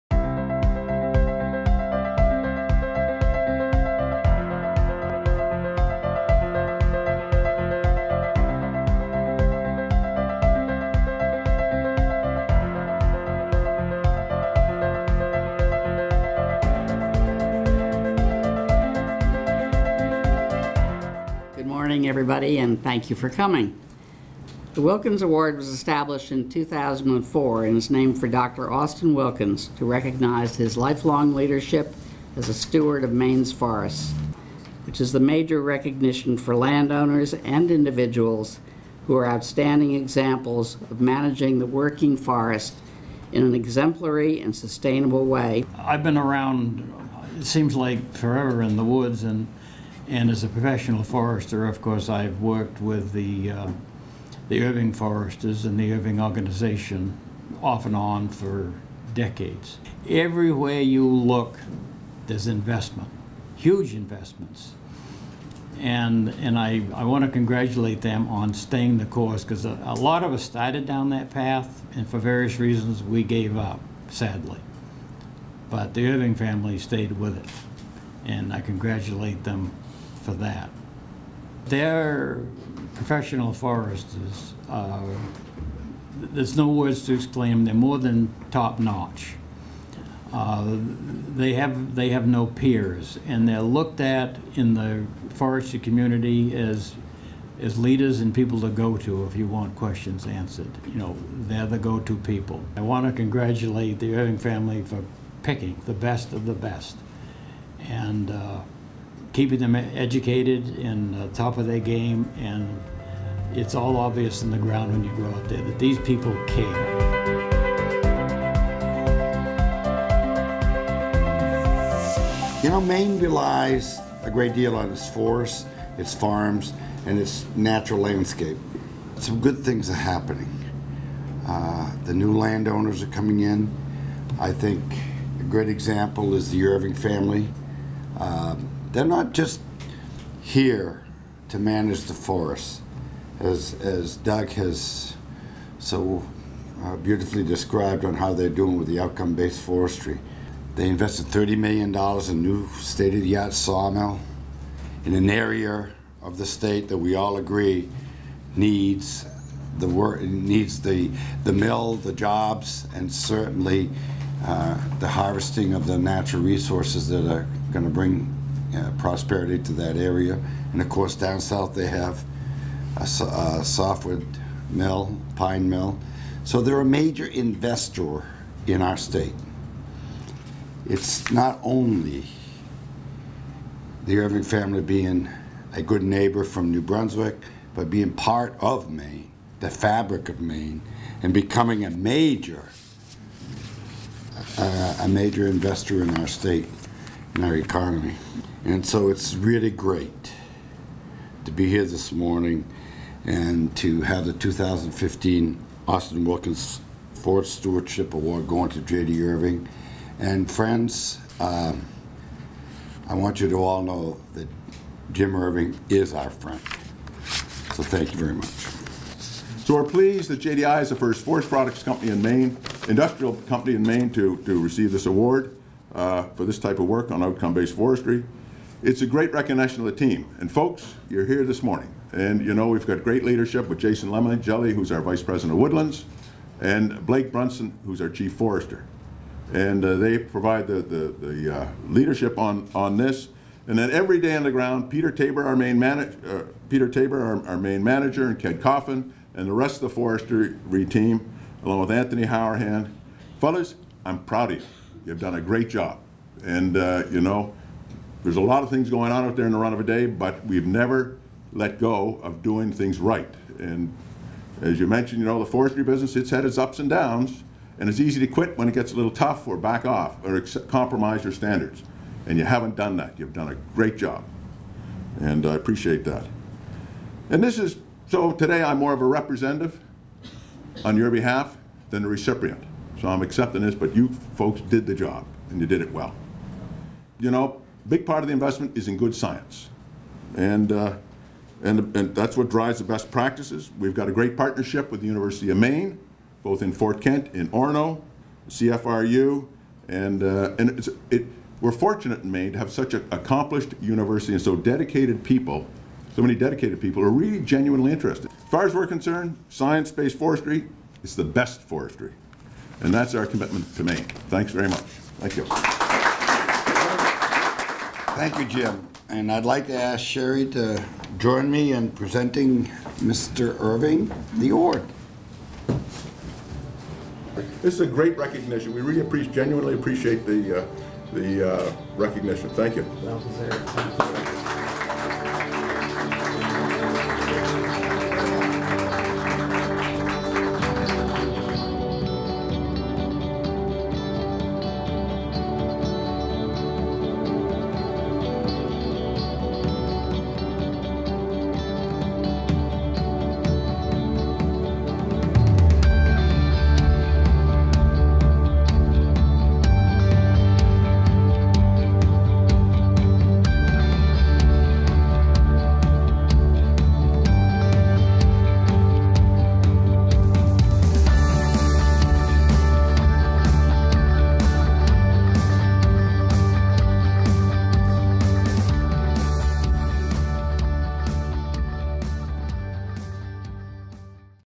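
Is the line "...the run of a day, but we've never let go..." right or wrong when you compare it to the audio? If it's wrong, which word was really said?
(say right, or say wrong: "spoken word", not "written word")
right.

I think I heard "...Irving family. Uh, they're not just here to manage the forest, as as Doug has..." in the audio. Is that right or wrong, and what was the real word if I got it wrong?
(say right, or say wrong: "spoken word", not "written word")
right.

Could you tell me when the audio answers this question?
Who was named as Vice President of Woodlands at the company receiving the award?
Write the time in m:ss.
3:53.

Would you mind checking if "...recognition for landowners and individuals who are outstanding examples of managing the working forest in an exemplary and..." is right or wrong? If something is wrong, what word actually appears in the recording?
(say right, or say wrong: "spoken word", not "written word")
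right.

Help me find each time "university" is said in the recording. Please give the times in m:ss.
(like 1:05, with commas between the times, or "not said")
4:55, 5:03.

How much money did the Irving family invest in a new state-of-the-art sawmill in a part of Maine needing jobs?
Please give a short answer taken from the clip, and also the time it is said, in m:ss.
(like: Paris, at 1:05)
$30 million, at 2:31.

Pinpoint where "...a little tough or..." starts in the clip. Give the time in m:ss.
4:28.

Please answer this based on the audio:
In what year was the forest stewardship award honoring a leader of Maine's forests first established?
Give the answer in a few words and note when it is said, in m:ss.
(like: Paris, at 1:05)
2004, at 0:26.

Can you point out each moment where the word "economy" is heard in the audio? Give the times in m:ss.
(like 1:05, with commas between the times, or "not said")
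3:17.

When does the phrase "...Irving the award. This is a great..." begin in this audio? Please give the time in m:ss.
5:23.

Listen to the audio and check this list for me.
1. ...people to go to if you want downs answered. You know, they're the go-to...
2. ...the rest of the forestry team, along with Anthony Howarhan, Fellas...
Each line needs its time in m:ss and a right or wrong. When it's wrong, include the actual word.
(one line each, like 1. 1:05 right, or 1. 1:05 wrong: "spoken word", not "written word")
1. 1:38 wrong: "questions", not "downs"
2. 4:09 right.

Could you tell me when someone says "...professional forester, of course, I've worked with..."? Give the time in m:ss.
0:50.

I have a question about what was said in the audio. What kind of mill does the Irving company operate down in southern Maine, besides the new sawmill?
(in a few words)
pine mill.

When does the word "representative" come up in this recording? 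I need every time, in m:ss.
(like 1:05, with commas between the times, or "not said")
4:39.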